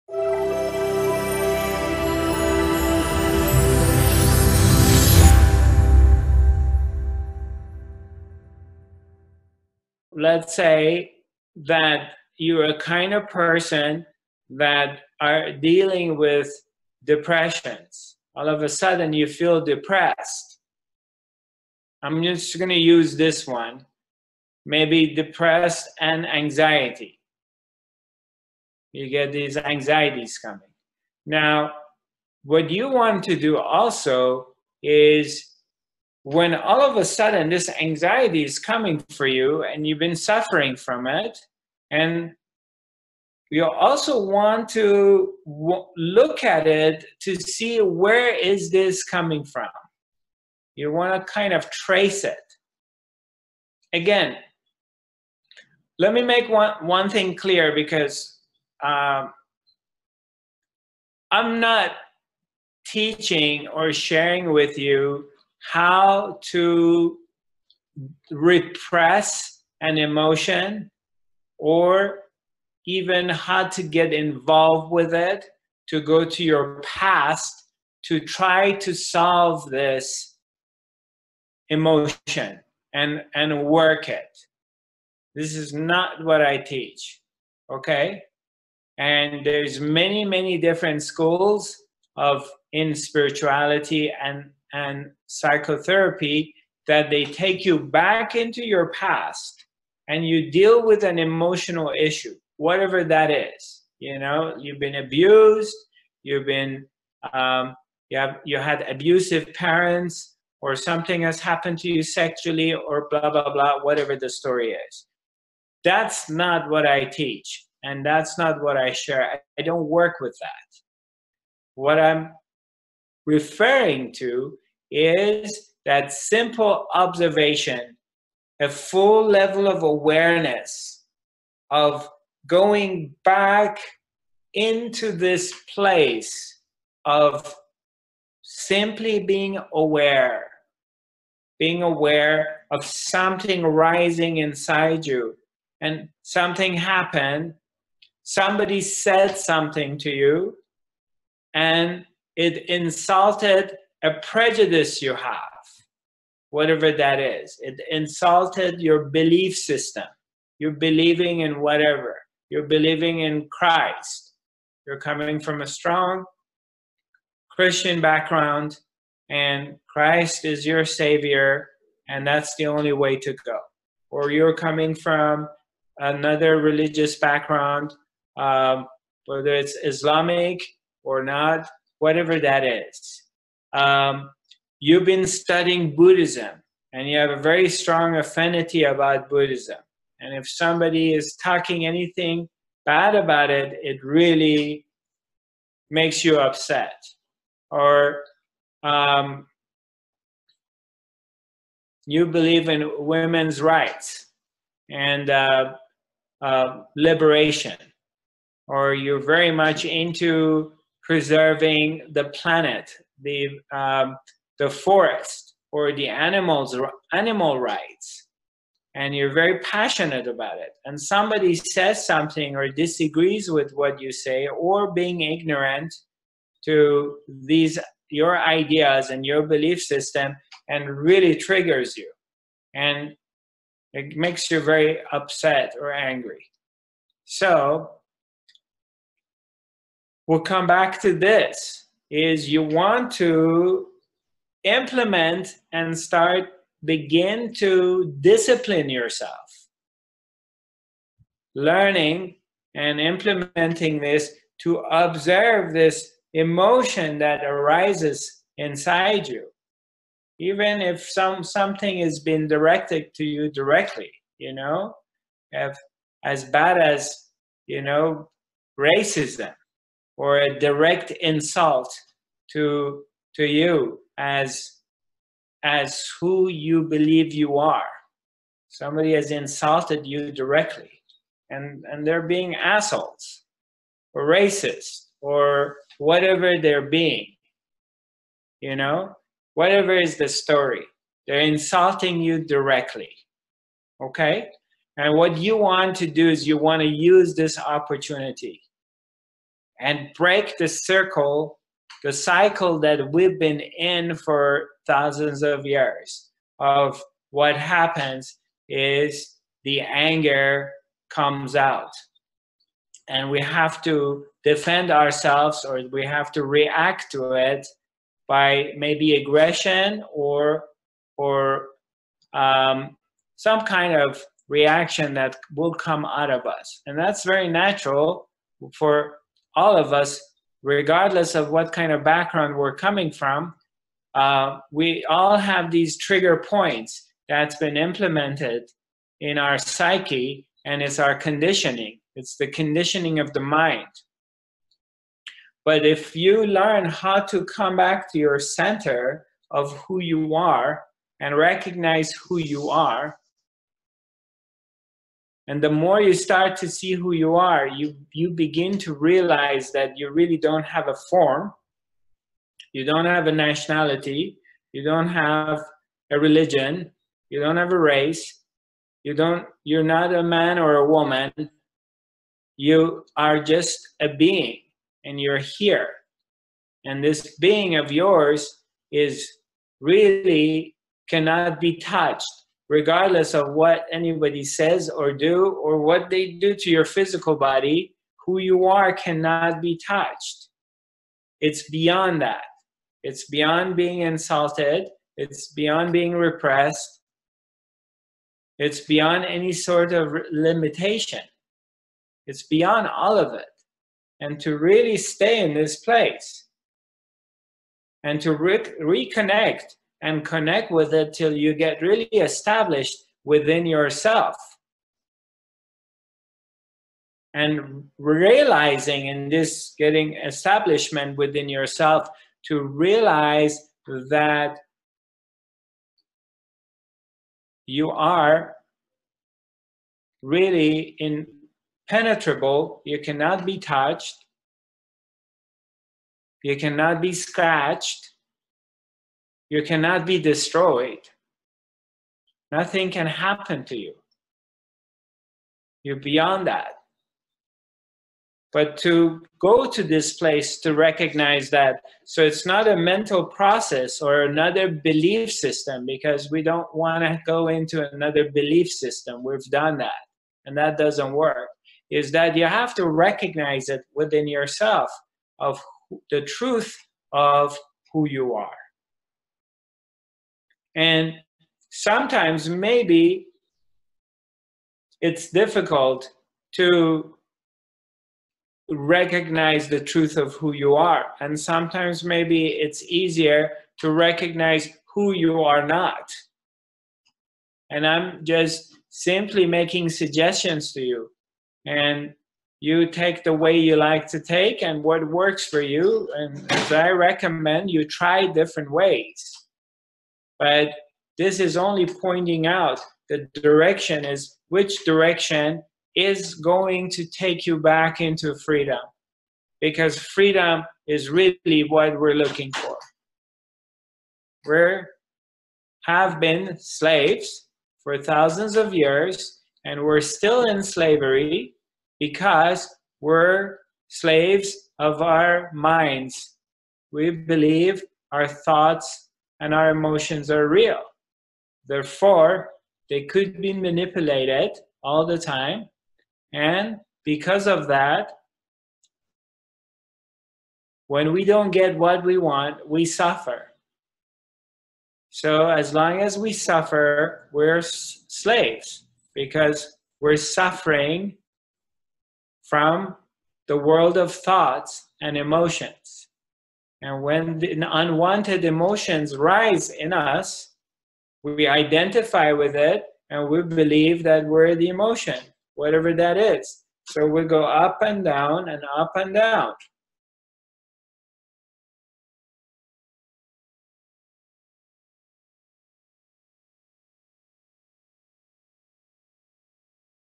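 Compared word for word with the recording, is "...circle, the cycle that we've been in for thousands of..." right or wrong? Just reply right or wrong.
right.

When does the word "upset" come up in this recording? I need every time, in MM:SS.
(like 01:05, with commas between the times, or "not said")
03:16, 03:55.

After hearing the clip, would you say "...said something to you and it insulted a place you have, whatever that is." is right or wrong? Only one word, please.
wrong.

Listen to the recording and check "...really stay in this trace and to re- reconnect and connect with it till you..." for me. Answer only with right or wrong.
wrong.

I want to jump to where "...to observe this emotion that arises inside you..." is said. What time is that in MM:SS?
04:14.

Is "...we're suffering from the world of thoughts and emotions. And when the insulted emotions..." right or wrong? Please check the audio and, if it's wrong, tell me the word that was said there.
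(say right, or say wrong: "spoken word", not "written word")
wrong: "unwanted", not "insulted".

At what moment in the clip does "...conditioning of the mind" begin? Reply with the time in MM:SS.
05:42.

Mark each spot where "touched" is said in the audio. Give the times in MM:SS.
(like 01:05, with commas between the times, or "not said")
06:21, 06:29, 07:13.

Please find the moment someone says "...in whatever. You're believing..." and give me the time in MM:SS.
02:41.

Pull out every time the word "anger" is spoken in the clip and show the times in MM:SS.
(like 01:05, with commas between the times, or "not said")
05:09.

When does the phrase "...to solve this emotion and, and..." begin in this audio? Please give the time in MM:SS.
01:18.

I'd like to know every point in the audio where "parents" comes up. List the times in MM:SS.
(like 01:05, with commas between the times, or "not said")
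01:49.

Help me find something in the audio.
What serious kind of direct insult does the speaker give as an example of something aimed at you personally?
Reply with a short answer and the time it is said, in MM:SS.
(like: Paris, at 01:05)
Racism, at 04:28.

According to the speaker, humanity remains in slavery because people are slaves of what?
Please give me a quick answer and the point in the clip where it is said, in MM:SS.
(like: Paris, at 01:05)
Our minds, at 08:45.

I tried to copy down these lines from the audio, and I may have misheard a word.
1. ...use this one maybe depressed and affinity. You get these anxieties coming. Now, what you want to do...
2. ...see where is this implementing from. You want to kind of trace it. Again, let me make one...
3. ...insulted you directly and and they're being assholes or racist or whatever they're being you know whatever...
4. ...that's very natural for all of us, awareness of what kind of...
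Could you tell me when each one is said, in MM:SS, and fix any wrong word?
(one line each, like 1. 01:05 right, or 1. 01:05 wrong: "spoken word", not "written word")
1. 00:22 wrong: "anxiety", not "affinity"
2. 00:47 wrong: "coming", not "implementing"
3. 04:39 right
4. 05:26 wrong: "regardless", not "awareness".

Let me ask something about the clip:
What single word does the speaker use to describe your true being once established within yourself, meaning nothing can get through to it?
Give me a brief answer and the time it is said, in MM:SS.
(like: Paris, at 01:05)
Impenetrable, at 07:11.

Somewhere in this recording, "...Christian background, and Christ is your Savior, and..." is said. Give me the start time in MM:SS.
02:47.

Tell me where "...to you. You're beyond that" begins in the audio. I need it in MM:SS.
07:23.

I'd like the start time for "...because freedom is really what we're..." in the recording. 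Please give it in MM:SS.
08:29.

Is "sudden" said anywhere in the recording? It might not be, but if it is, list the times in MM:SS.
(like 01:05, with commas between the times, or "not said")
00:18, 00:37.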